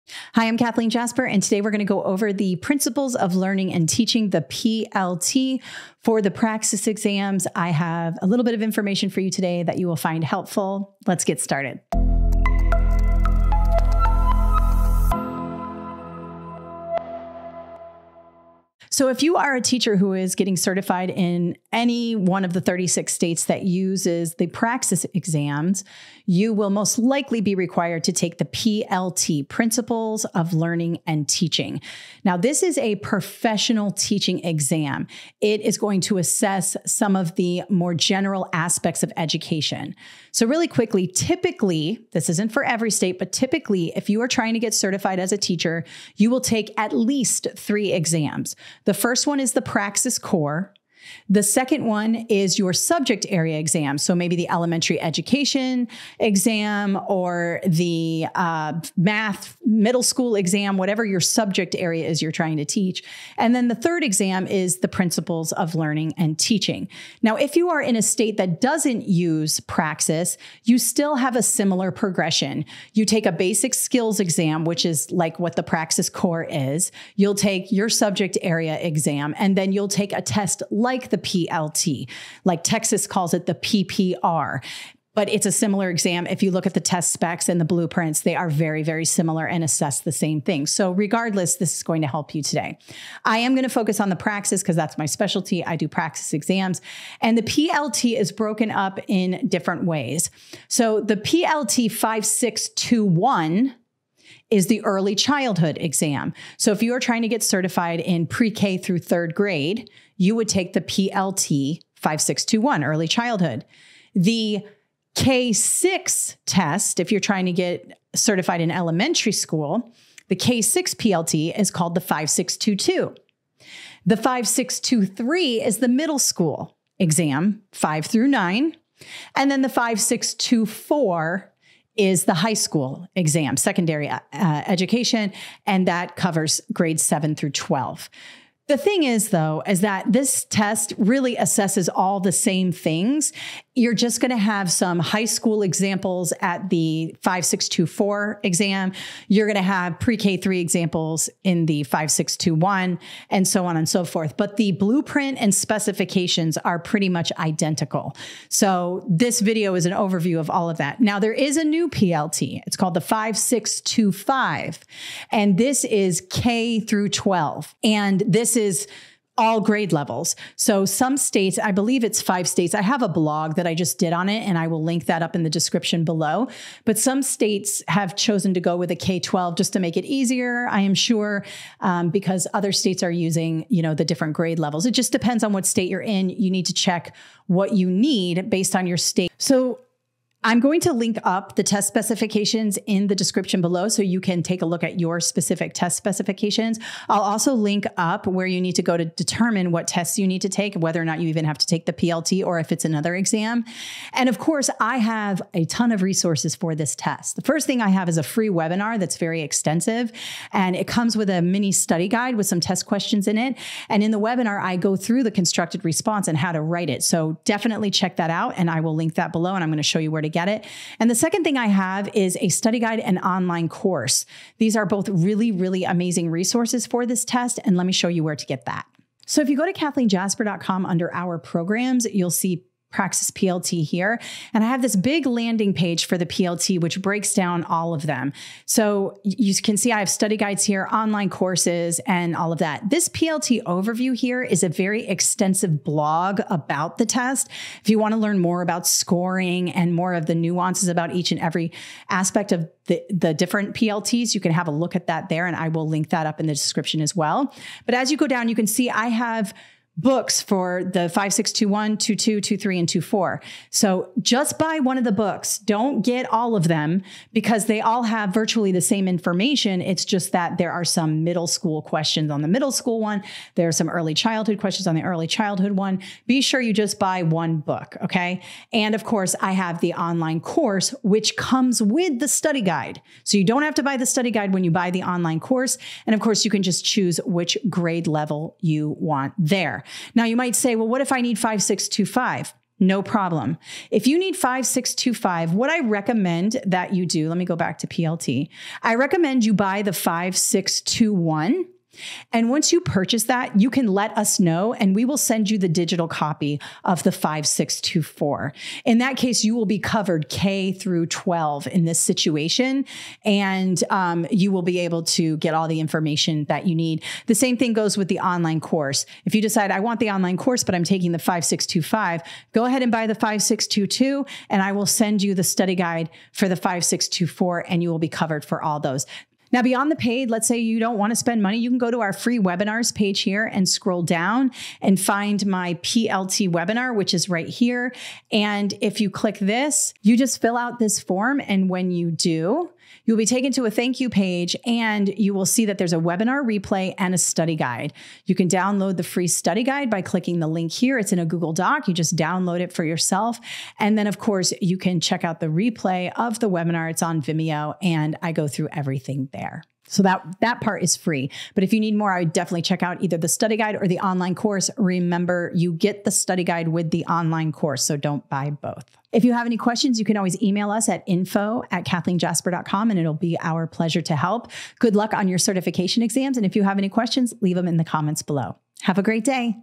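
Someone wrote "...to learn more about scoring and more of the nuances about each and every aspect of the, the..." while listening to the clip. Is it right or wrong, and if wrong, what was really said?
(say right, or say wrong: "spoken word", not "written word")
right.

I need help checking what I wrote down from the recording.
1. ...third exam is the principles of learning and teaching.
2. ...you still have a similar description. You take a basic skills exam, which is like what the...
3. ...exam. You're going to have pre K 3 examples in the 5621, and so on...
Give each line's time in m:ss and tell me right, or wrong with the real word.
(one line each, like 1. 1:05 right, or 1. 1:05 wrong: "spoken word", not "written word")
1. 1:03 right
2. 1:10 wrong: "progression", not "description"
3. 2:28 right.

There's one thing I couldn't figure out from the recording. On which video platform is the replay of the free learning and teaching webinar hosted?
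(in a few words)
Vimeo.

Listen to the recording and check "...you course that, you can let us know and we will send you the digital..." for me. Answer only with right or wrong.
wrong.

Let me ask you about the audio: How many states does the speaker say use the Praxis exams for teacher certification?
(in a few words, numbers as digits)
36.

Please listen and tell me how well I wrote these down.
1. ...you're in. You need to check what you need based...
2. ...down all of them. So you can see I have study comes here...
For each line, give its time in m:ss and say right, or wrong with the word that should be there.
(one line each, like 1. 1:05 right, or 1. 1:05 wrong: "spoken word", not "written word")
1. 3:05 right
2. 3:57 wrong: "guides", not "comes".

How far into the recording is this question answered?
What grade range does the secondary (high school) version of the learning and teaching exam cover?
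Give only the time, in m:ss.
2:17.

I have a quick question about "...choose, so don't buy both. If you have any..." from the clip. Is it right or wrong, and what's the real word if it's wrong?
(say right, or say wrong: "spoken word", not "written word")
wrong: "course", not "choose".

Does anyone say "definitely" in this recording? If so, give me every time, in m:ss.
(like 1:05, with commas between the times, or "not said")
3:37, 6:02.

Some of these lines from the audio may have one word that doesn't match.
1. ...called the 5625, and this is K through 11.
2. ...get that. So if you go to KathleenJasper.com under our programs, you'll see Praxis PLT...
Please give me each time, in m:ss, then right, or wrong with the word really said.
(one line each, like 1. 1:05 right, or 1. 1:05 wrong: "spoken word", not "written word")
1. 2:42 wrong: "12", not "11"
2. 3:48 right.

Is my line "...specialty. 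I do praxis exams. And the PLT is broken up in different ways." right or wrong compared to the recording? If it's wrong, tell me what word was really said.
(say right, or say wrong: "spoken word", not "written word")
right.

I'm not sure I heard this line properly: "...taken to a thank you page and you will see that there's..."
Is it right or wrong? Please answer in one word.
right.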